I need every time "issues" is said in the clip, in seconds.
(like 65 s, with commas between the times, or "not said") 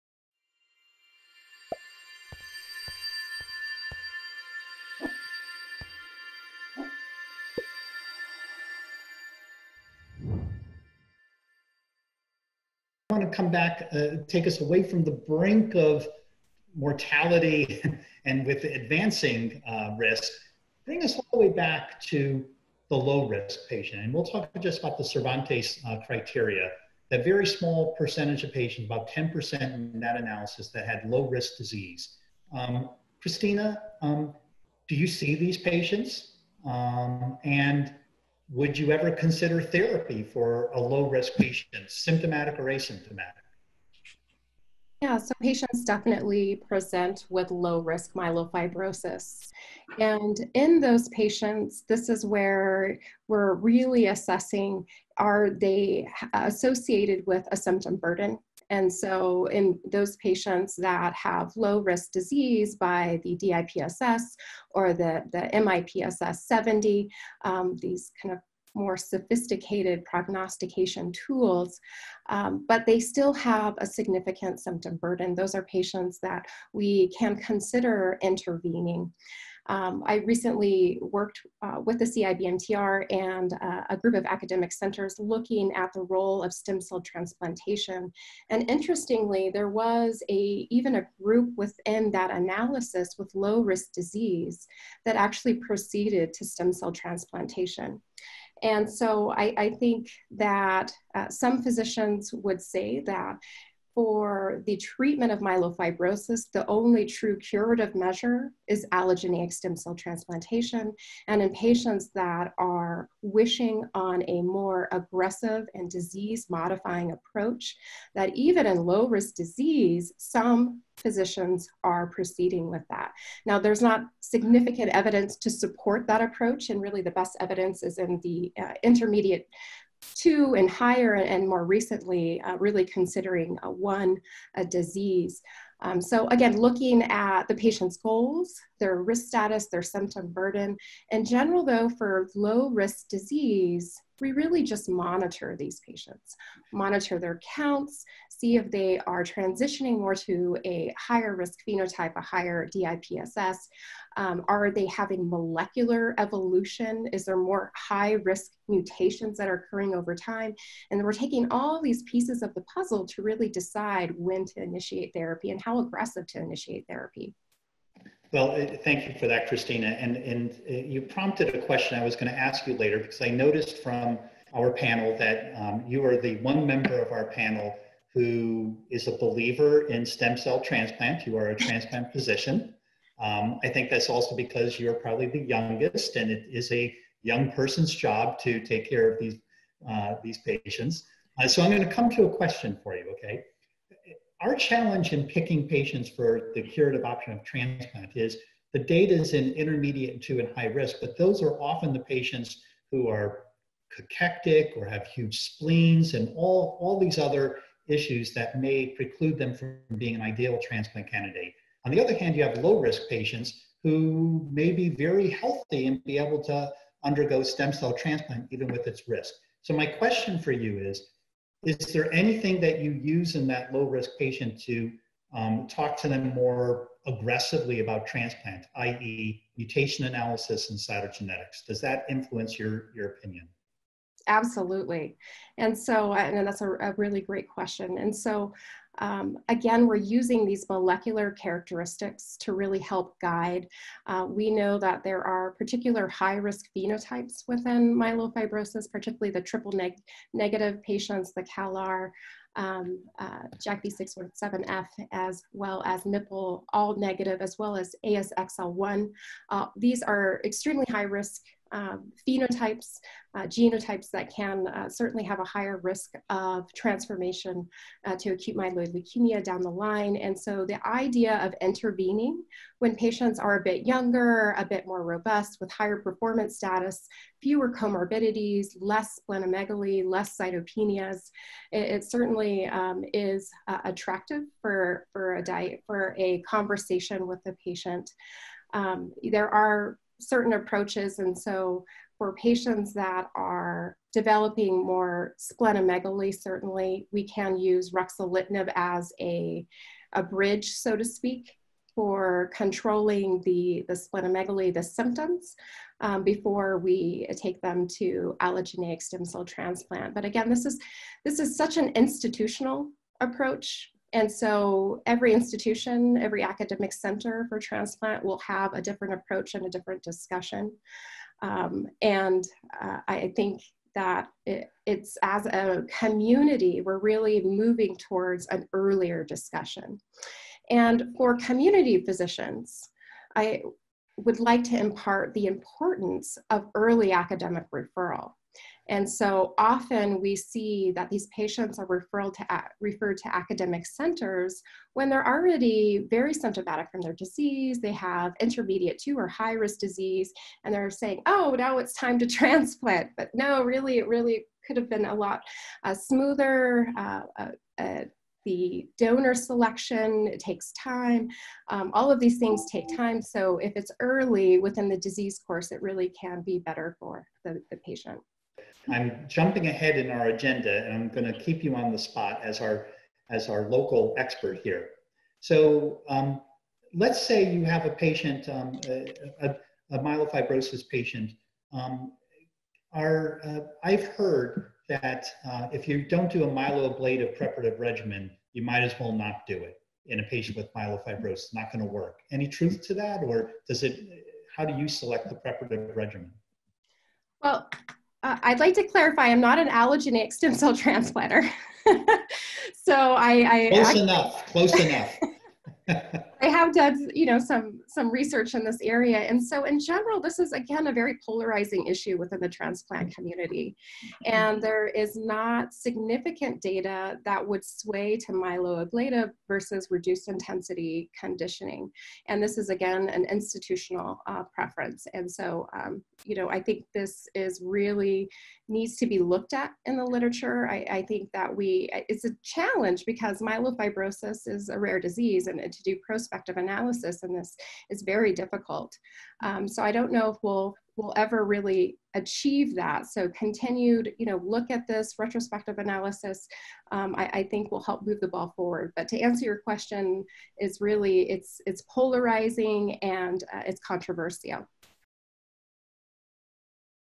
207 s, 411 s.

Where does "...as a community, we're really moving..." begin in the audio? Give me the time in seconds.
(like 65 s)
325 s.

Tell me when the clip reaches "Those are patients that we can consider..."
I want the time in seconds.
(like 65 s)
75 s.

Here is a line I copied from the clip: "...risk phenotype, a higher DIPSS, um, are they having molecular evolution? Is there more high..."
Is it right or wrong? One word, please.
right.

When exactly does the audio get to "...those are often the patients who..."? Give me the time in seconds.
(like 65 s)
201 s.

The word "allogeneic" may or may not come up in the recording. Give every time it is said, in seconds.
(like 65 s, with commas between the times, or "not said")
108 s, 308 s, 399 s.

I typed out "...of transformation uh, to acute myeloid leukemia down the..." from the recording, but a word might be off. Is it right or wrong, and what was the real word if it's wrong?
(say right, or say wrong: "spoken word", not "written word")
right.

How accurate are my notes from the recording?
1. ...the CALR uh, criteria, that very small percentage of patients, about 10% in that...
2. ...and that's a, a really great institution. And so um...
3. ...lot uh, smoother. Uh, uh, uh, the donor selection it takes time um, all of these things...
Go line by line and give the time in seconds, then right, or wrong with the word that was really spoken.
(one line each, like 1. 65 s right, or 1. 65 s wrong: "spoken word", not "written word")
1. 24 s wrong: "Cervantes", not "CALR"
2. 236 s wrong: "question", not "institution"
3. 355 s right.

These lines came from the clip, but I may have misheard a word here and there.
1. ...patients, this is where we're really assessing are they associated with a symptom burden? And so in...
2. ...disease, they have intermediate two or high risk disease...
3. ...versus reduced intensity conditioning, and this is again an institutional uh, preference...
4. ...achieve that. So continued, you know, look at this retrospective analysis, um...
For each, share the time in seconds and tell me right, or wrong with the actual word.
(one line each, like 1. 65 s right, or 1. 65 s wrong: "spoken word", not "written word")
1. 51 s right
2. 347 s right
3. 419 s right
4. 442 s right.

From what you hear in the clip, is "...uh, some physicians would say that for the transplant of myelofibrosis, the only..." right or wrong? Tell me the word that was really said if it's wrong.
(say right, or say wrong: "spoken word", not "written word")
wrong: "treatment", not "transplant".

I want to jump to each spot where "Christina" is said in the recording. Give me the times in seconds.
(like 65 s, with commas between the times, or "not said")
33 s, 169 s.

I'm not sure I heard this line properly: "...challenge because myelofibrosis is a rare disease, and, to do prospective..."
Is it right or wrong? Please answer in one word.
right.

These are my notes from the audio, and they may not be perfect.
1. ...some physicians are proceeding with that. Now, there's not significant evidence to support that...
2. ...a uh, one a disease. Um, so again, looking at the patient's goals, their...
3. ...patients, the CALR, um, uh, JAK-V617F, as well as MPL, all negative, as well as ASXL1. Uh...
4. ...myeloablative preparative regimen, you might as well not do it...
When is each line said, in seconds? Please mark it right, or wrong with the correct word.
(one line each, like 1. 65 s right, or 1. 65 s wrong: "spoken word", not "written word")
1. 120 s right
2. 133 s right
3. 250 s right
4. 386 s right.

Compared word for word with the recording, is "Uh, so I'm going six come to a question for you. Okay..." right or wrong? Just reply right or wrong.
wrong.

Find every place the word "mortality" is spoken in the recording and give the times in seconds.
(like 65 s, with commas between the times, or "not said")
16 s.